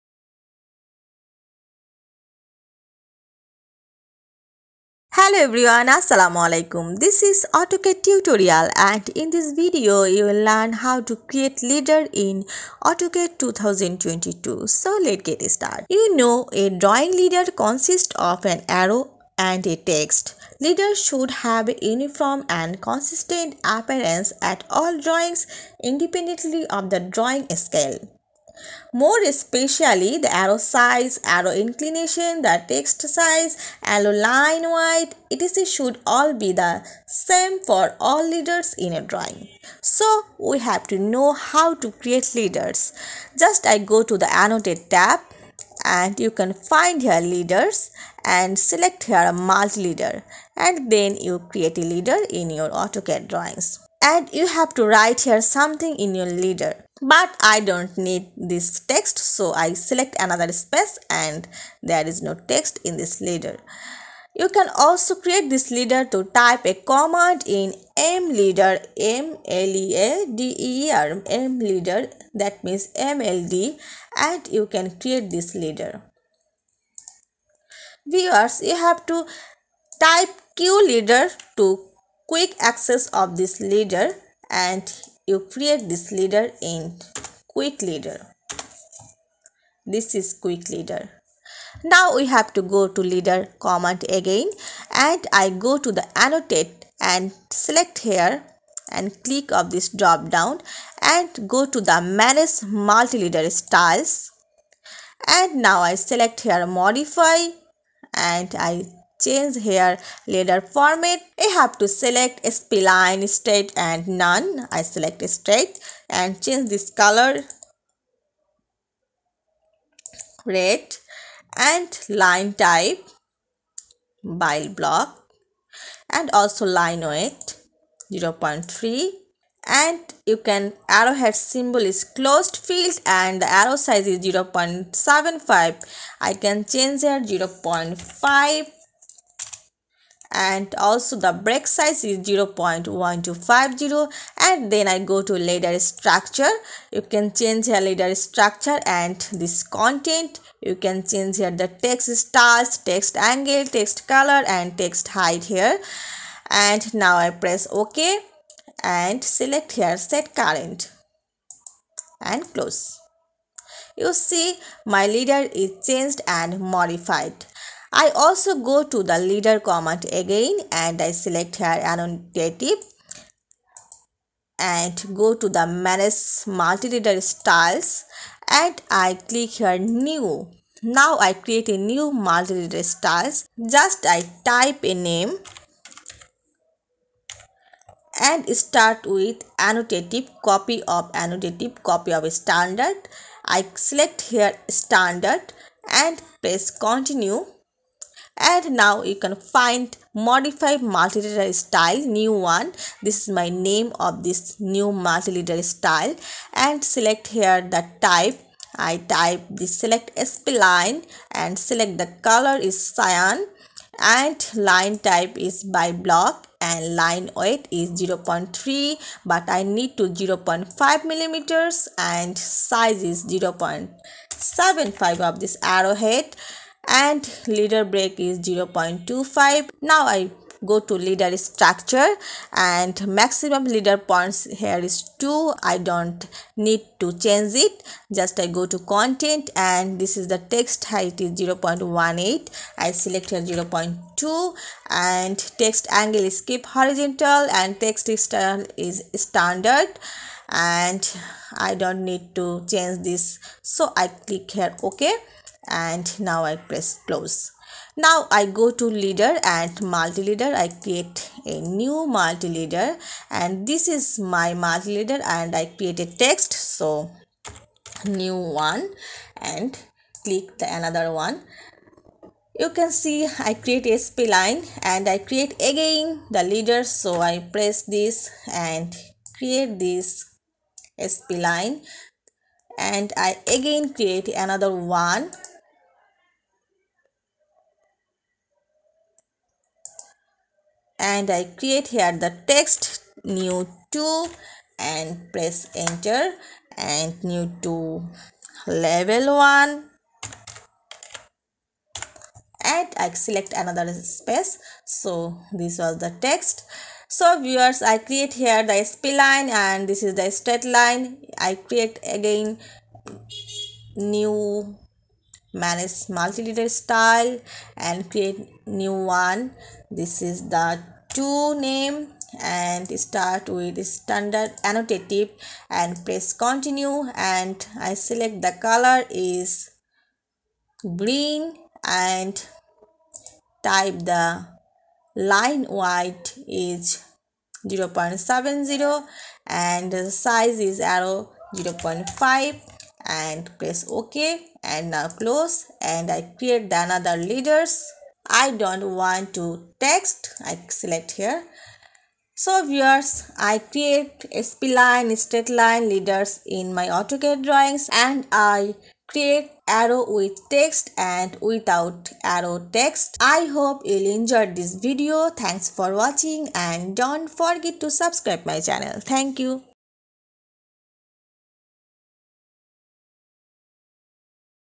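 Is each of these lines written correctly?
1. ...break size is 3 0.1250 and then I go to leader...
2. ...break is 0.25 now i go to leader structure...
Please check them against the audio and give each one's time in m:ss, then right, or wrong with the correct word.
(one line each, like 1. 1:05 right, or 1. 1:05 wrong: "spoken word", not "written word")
1. 2:21 wrong: "0", not "3"
2. 3:47 right.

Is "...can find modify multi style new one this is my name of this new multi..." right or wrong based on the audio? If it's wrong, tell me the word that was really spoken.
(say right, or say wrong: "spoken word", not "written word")
right.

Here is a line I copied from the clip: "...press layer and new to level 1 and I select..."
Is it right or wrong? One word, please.
wrong.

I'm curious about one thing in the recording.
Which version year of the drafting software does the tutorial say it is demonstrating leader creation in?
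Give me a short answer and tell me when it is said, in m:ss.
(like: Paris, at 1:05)
2022, at 0:12.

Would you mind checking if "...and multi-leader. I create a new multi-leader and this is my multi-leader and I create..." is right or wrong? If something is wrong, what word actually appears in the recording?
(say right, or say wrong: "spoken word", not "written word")
right.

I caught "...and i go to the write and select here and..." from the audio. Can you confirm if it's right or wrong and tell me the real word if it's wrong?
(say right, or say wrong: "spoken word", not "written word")
wrong: "annotate", not "write".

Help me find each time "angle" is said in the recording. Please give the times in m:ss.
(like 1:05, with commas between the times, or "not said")
2:33, 4:05.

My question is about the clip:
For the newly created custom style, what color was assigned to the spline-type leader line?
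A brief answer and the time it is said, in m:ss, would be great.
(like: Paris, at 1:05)
cyan, at 3:32.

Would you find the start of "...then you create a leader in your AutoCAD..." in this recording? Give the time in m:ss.
0:50.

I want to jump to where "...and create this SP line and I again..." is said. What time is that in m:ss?
4:38.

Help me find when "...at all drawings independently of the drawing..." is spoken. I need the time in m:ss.
0:24.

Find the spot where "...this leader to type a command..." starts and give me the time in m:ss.
1:05.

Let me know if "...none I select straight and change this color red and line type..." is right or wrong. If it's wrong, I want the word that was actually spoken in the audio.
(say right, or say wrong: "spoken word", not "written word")
right.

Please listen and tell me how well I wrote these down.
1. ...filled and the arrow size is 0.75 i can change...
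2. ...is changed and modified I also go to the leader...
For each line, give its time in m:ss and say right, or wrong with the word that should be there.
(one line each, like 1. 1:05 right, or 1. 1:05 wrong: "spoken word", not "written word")
1. 2:12 right
2. 2:45 right.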